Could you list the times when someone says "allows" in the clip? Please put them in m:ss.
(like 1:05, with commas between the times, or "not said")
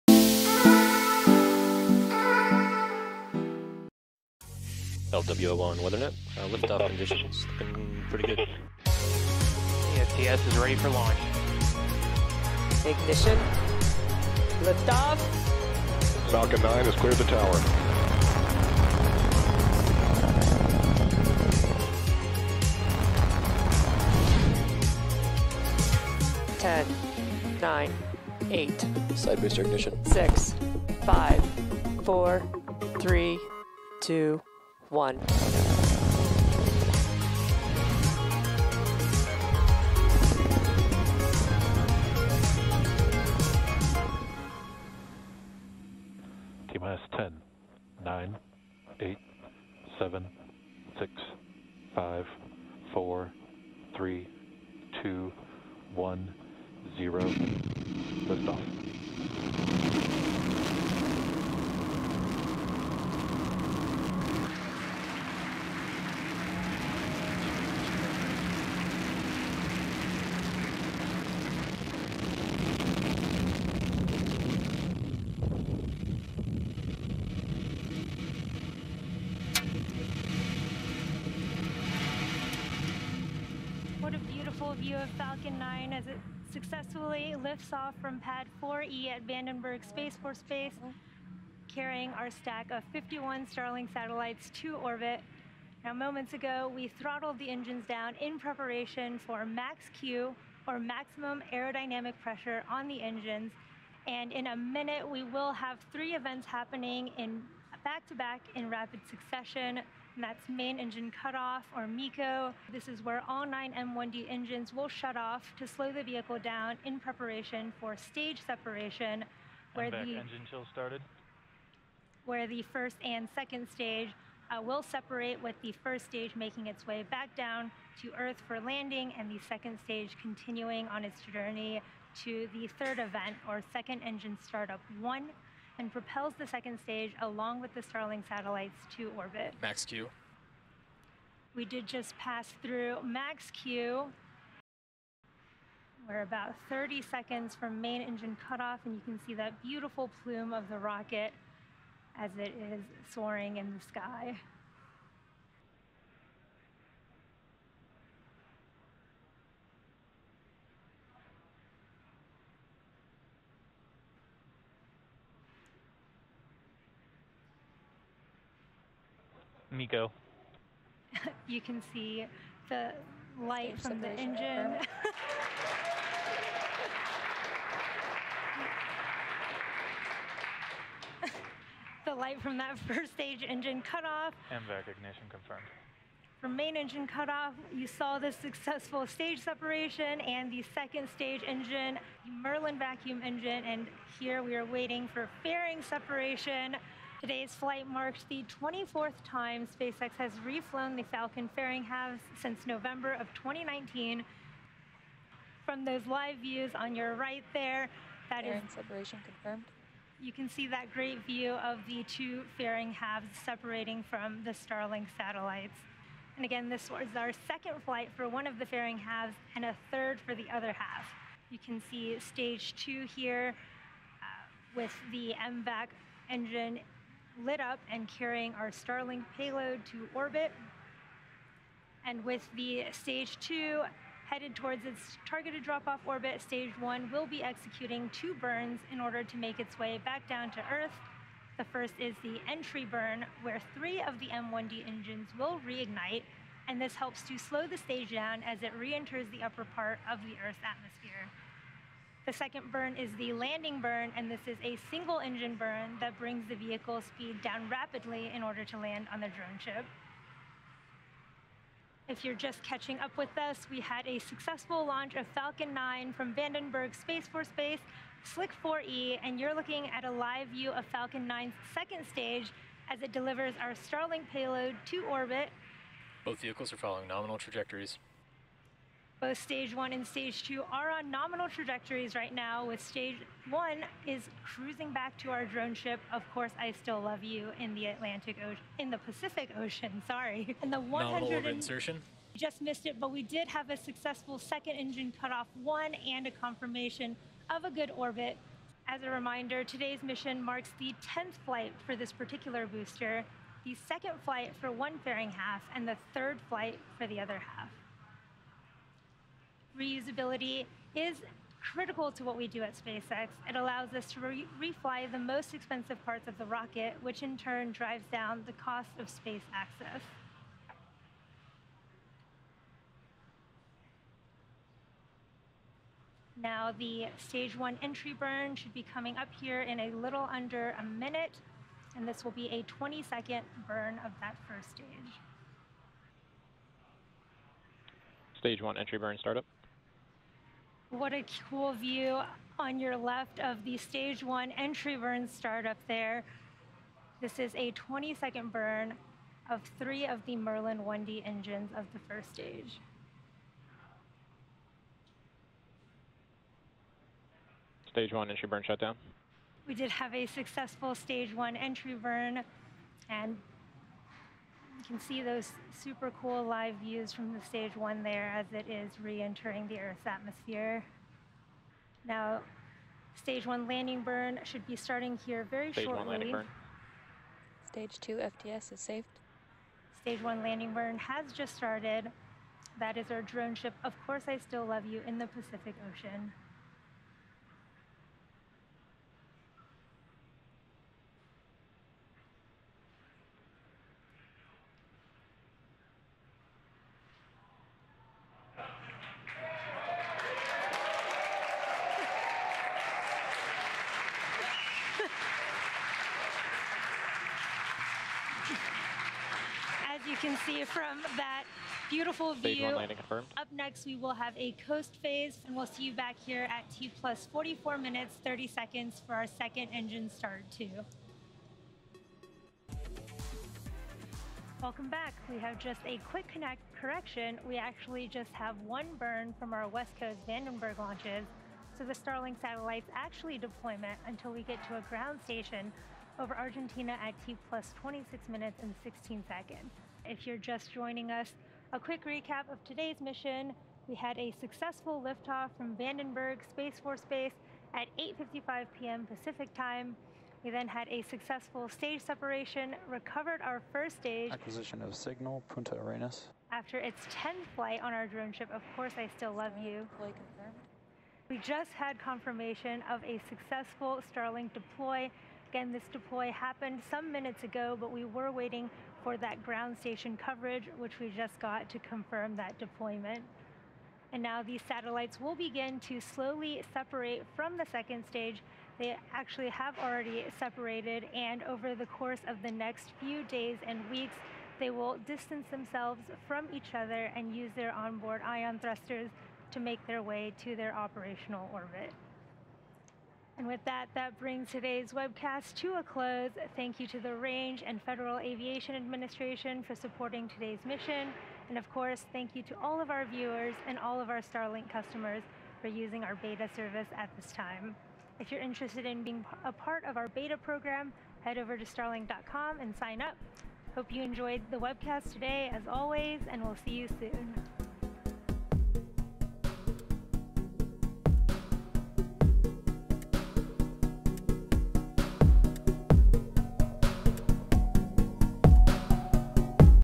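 5:13.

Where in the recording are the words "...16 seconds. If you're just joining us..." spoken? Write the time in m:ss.
7:18.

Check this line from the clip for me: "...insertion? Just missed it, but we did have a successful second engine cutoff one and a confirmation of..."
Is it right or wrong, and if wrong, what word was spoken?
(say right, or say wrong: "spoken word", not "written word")
right.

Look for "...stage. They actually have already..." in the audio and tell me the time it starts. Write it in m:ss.
7:58.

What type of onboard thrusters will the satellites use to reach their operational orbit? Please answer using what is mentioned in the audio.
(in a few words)
Ion thrusters.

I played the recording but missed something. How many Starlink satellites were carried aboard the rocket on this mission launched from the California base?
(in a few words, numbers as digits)
51.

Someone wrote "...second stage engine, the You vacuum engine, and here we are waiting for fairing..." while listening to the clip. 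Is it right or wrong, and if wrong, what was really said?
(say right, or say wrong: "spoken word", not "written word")
wrong: "Merlin", not "You".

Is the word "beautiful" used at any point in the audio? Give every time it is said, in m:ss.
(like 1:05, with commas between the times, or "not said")
1:24, 2:29, 6:51.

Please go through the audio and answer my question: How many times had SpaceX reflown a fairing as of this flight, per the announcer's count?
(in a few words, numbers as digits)
24.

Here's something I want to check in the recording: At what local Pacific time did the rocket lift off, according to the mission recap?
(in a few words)
8:55 p.m.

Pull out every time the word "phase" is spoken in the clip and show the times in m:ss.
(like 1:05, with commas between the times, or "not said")
6:55.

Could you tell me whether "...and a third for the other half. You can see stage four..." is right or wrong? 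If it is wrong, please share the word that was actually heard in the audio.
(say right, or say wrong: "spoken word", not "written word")
wrong: "two", not "four".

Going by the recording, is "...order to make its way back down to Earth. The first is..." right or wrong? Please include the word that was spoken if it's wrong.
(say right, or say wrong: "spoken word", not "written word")
right.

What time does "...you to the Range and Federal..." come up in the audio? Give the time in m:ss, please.
8:16.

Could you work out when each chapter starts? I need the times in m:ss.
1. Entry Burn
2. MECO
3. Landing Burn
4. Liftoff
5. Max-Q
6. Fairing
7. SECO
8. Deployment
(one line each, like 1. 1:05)
1. 5:37
2. 2:48
3. 6:15
4. 0:59
5. 2:18
6. 3:28
7. 4:51
8. 7:39.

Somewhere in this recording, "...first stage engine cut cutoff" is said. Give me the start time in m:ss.
3:02.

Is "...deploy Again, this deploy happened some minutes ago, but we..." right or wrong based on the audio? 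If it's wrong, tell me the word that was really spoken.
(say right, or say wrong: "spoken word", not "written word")
right.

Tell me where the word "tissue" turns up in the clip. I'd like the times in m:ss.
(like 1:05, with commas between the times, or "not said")
not said.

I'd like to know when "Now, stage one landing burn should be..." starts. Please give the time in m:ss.
6:12.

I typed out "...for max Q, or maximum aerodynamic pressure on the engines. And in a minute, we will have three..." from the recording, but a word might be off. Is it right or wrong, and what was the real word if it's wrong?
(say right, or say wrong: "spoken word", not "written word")
right.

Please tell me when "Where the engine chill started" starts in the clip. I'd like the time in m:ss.
1:59.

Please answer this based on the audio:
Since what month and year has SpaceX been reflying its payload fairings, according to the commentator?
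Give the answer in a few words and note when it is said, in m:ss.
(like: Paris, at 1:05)
November 2019, at 3:22.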